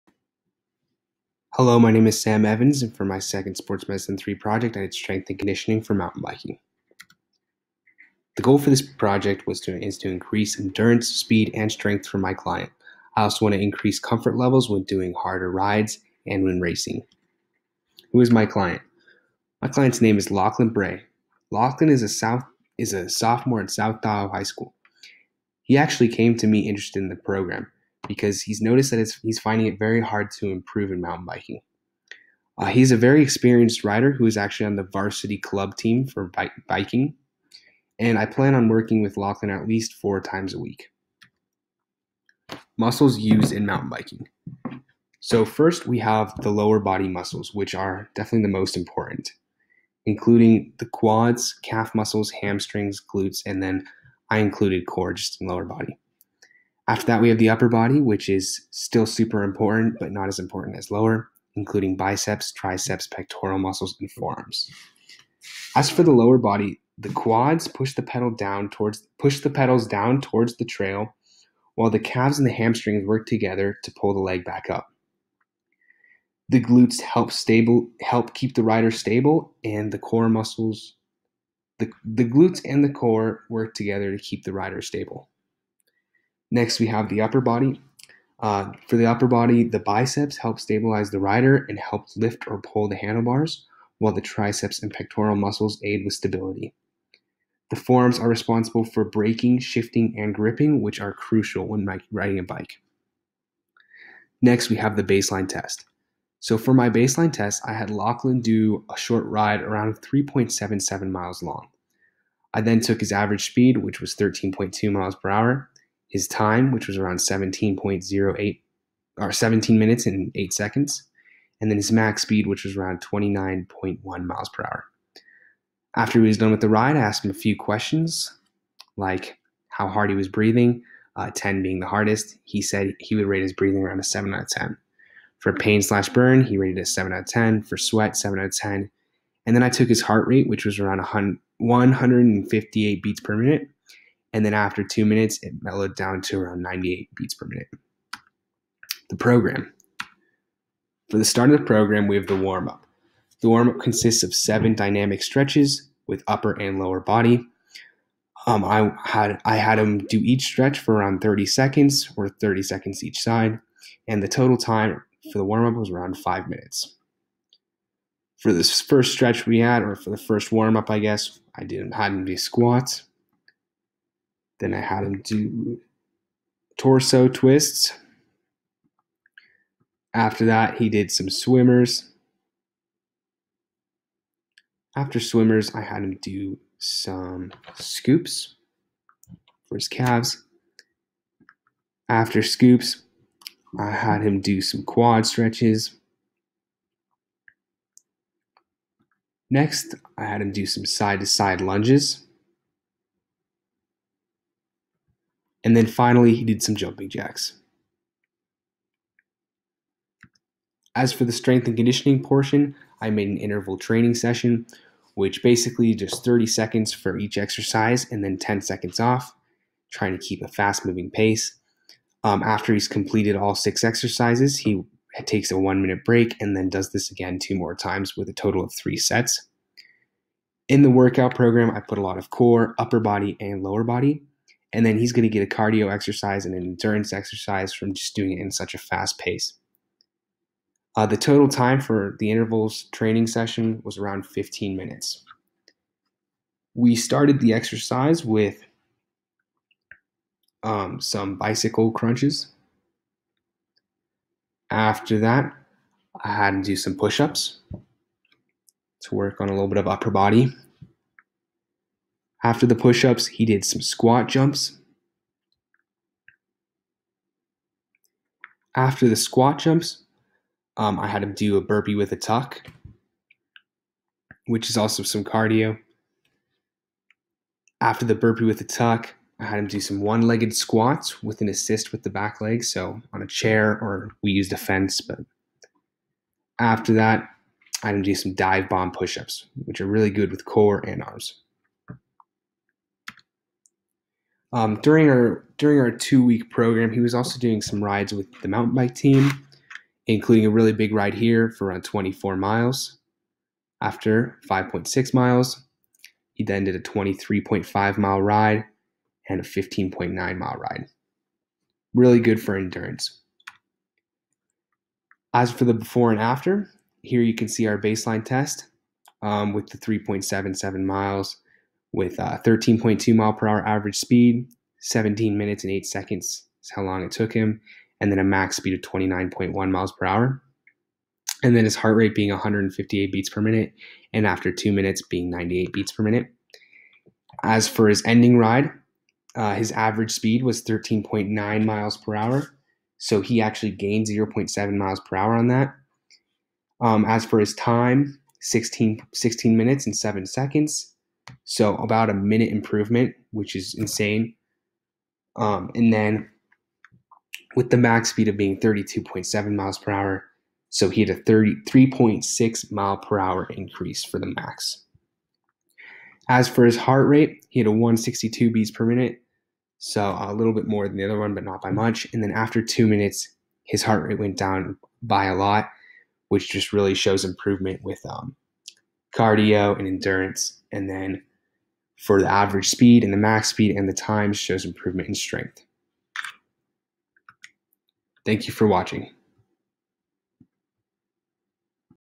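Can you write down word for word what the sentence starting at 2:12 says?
He said he would rate his breathing around a 7 out of 10.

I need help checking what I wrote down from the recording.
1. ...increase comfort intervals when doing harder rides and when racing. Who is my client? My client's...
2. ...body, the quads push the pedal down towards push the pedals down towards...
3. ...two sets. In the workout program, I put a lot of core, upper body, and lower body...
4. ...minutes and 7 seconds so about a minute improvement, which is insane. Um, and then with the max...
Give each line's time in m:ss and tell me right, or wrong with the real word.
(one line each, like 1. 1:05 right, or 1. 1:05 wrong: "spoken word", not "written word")
1. 0:13 wrong: "levels", not "intervals"
2. 1:06 right
3. 3:48 wrong: "three", not "two"
4. 5:49 right.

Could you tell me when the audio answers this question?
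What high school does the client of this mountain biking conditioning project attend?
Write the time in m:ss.
0:23.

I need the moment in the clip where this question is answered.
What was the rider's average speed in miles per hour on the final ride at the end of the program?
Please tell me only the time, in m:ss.
5:40.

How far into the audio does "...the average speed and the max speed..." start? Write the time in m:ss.
6:22.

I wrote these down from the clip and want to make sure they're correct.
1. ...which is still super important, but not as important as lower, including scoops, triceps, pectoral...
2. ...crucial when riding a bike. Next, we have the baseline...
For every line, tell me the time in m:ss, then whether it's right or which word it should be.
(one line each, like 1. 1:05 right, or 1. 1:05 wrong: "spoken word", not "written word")
1. 0:58 wrong: "biceps", not "scoops"
2. 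1:41 right.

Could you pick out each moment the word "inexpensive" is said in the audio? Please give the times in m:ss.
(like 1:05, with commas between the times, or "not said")
not said.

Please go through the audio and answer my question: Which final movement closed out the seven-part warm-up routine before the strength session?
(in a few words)
jumping jacks.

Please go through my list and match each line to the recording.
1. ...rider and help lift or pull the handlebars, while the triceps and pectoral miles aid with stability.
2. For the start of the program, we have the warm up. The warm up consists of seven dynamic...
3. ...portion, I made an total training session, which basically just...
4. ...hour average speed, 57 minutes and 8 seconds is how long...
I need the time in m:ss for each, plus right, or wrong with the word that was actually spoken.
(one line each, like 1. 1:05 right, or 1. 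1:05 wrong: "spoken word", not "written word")
1. 1:31 wrong: "muscles", not "miles"
2. 2:31 right
3. 3:32 wrong: "interval", not "total"
4. 5:23 wrong: "17", not "57".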